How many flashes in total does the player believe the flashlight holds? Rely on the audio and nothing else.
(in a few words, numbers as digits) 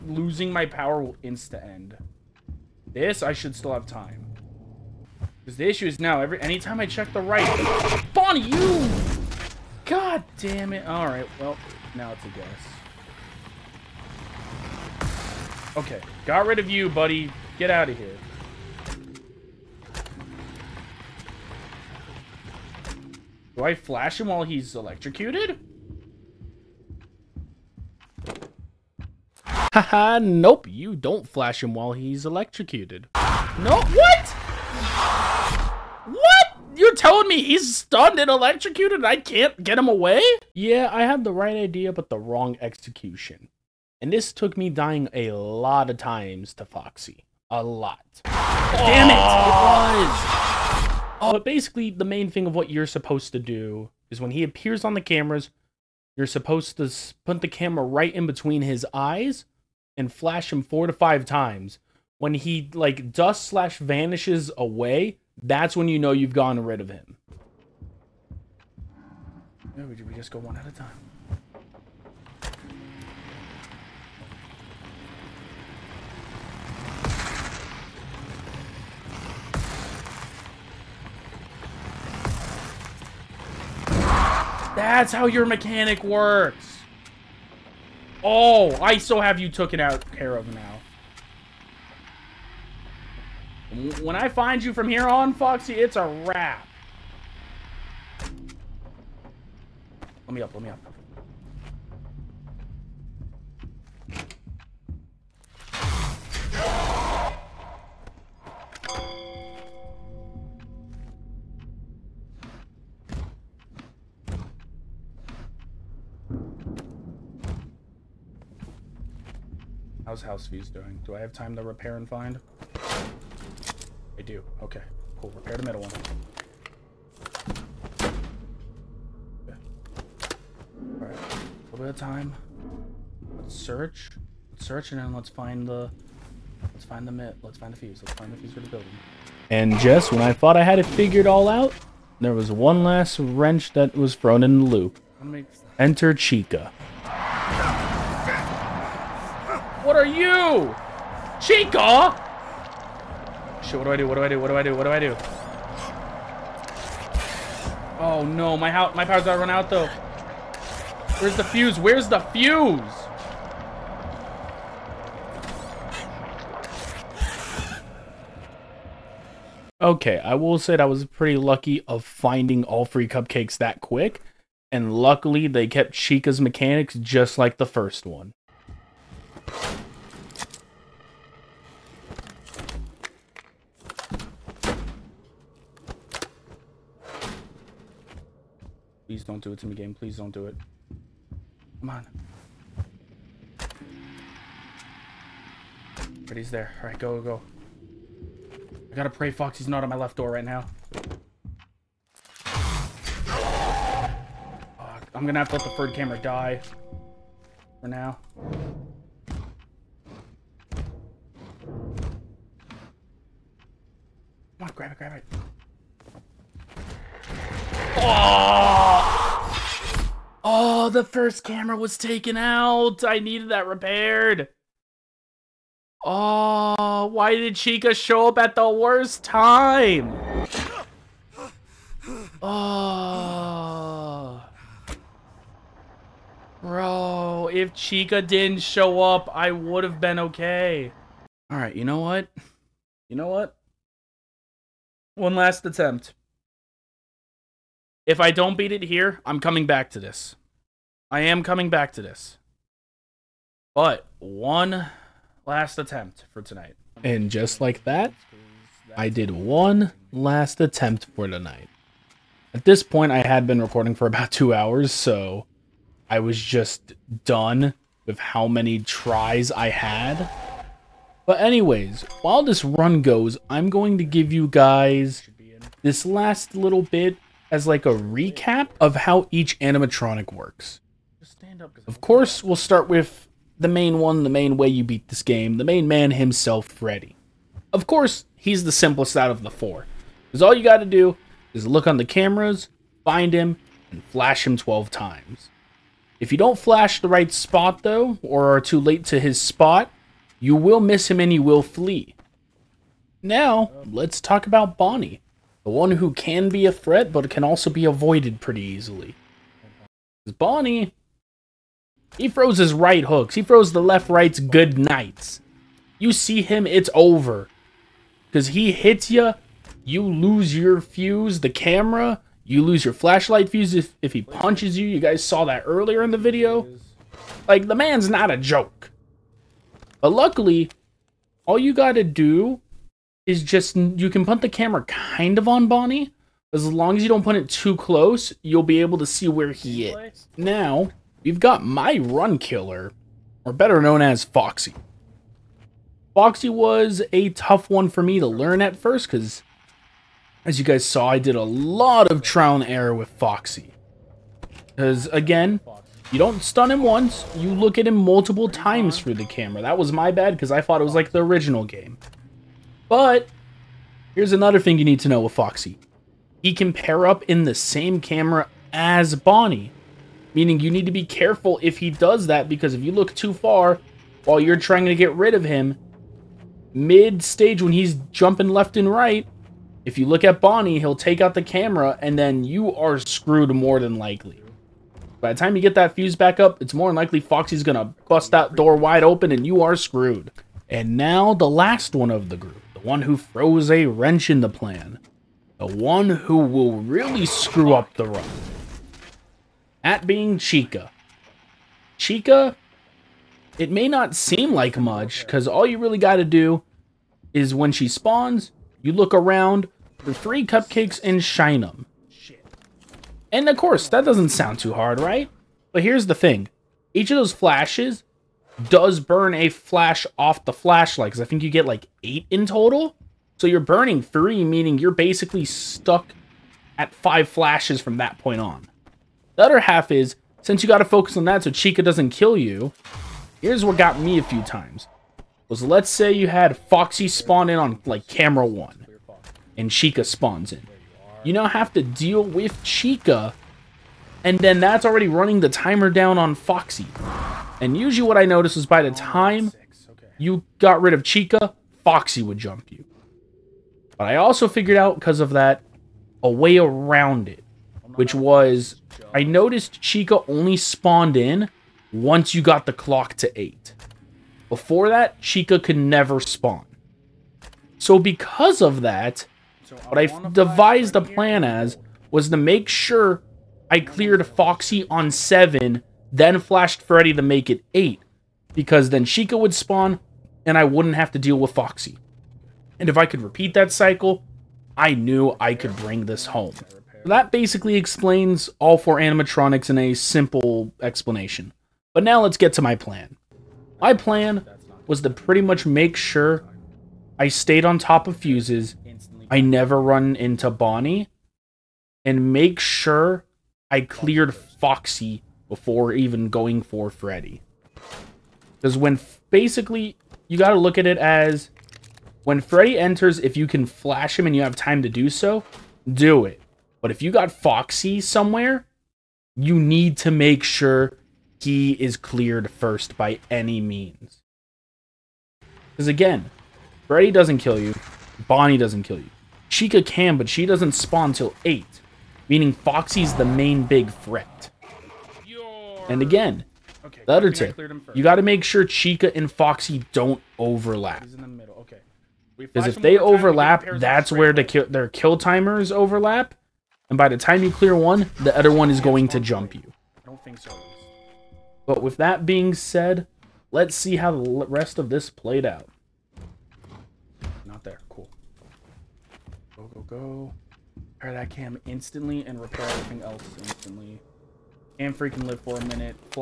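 8.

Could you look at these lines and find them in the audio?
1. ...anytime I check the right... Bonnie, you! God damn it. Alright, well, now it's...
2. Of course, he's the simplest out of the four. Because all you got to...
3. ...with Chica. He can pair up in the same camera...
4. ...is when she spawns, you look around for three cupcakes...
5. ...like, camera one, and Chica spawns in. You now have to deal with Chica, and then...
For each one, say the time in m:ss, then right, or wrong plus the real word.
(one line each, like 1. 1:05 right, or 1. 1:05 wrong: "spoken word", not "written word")
1. 0:06 right
2. 4:47 right
3. 6:05 wrong: "Foxy", not "Chica"
4. 6:47 right
5. 7:17 right.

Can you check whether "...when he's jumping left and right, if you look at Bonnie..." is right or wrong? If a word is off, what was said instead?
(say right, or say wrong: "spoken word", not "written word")
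right.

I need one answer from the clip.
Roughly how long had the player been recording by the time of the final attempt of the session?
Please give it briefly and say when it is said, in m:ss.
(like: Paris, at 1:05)
about 2 hours, at 4:24.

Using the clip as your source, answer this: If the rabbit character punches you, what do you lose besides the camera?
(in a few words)
flashlight fuse.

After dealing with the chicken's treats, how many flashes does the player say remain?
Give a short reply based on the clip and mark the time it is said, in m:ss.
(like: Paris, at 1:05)
5, at 7:06.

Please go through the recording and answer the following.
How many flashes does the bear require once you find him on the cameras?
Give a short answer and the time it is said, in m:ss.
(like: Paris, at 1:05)
12, at 4:54.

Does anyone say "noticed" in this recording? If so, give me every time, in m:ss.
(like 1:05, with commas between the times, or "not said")
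7:28, 7:39.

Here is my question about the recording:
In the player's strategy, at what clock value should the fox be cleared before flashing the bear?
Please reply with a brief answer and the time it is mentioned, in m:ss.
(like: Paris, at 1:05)
7, at 7:55.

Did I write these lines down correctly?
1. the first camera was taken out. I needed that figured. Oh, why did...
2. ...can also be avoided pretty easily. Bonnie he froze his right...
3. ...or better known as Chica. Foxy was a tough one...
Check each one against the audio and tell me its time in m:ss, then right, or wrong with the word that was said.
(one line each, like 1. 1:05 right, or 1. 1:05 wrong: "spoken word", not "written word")
1. 3:40 wrong: "repaired", not "figured"
2. 5:07 right
3. 5:43 wrong: "Foxy", not "Chica".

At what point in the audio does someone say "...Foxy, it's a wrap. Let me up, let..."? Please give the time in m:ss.
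1:35.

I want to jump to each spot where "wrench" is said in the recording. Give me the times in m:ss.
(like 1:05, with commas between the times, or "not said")
2:23, 6:33.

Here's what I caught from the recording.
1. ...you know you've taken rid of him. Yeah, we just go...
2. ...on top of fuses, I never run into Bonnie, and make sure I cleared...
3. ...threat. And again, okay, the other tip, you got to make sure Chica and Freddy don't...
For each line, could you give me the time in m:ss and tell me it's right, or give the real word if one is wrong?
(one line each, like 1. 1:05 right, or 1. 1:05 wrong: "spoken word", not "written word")
1. 1:05 wrong: "gotten", not "taken"
2. 8:17 right
3. 8:53 wrong: "Foxy", not "Freddy".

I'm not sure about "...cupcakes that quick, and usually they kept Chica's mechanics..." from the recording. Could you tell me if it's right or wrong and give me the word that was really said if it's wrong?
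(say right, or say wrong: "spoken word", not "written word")
wrong: "luckily", not "usually".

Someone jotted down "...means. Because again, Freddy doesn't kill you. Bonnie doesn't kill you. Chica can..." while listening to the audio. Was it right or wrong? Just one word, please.
right.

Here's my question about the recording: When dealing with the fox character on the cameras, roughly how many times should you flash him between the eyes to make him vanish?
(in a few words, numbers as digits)
4 to 5.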